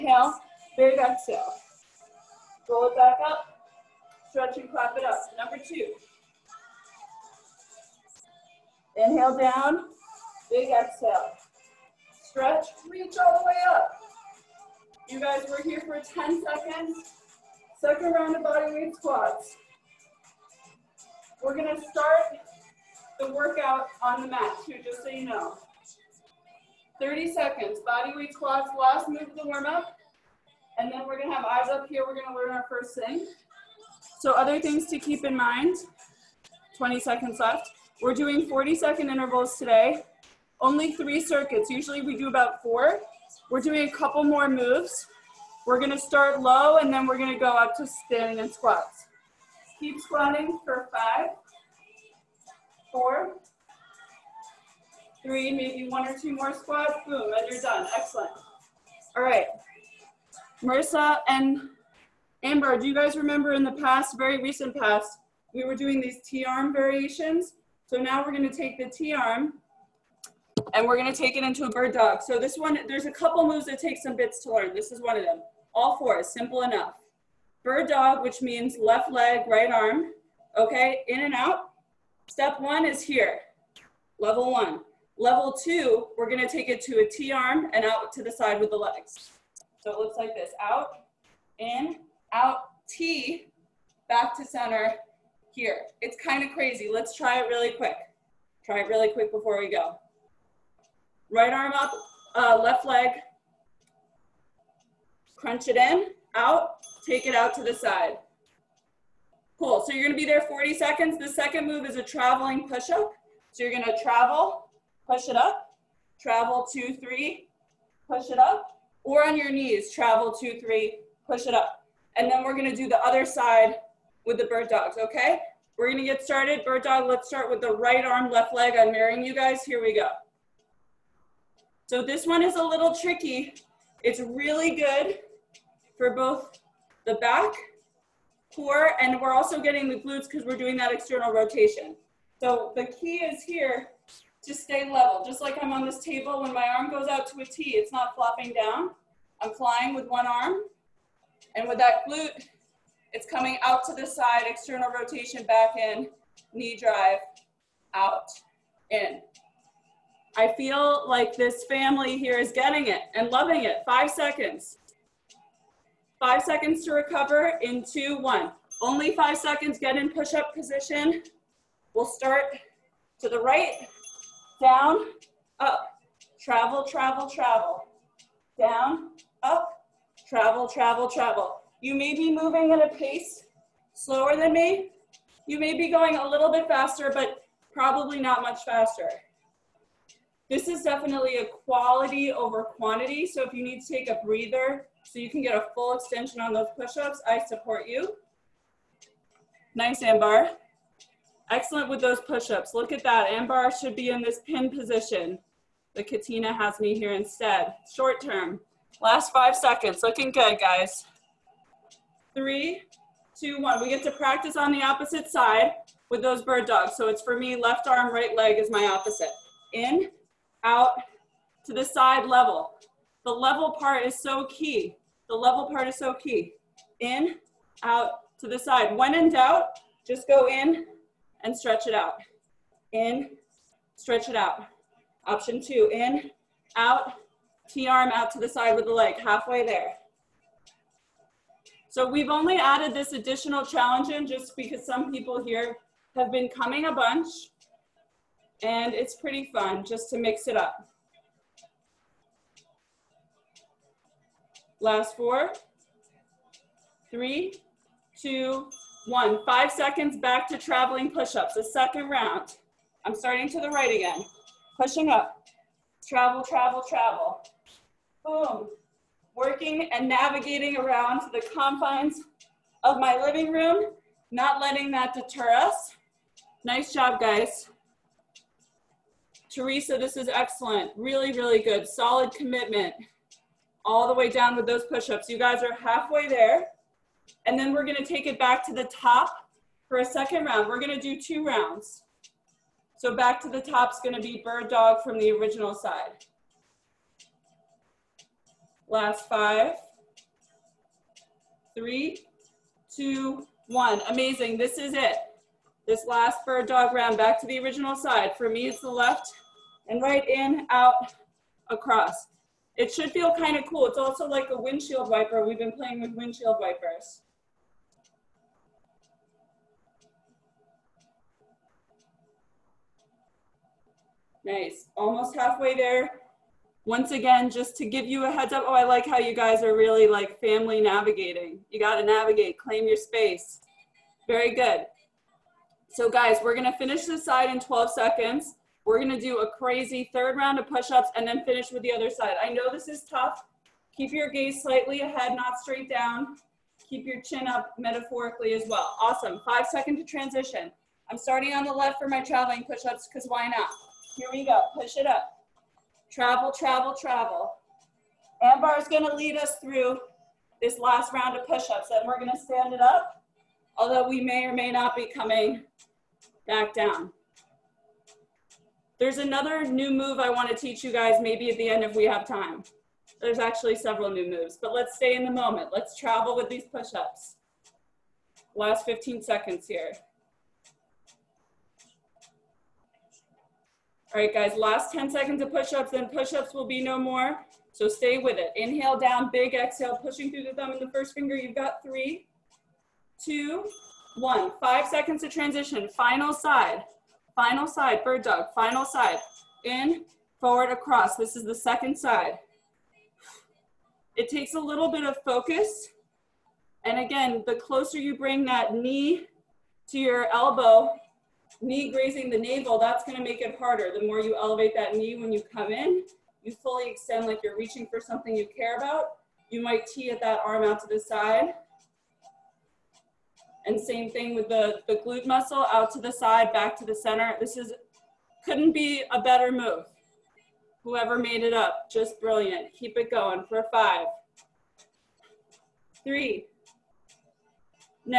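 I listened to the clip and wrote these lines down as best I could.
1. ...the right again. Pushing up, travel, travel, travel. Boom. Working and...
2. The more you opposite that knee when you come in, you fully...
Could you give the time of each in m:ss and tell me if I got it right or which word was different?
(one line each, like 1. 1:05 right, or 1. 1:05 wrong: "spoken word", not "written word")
1. 4:23 right
2. 6:53 wrong: "elevate", not "opposite".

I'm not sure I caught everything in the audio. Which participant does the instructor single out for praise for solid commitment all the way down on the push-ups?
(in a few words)
Teresa.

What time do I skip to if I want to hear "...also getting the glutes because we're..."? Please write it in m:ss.
2:19.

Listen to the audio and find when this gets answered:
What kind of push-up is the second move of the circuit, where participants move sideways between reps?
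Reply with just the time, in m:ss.
1:52.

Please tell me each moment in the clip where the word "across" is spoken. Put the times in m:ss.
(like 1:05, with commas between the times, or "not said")
5:11, 6:40.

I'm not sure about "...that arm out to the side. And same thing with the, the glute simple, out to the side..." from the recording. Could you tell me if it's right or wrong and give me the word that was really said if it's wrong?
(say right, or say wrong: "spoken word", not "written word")
wrong: "muscle", not "simple".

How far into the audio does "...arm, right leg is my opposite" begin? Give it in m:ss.
3:37.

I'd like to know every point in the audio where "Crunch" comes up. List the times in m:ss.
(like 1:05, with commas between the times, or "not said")
1:45.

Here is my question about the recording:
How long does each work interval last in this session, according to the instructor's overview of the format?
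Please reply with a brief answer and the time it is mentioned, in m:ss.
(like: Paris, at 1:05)
40 seconds, at 0:38.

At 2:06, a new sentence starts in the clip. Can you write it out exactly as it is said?
Bird dog, let's start with the right arm, left leg.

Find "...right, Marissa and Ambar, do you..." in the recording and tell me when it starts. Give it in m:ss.
0:59.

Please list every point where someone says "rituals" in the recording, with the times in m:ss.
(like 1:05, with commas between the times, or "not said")
not said.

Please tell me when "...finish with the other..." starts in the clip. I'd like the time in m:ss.
5:41.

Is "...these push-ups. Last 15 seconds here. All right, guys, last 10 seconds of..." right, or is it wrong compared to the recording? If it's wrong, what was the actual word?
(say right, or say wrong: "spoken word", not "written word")
right.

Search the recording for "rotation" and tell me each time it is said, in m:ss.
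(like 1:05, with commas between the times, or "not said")
2:21, 2:34.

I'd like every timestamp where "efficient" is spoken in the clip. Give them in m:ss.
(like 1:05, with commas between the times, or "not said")
not said.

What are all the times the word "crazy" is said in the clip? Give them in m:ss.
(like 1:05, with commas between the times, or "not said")
1:36, 5:39.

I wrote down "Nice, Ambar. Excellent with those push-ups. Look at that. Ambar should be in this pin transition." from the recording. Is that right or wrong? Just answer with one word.
wrong.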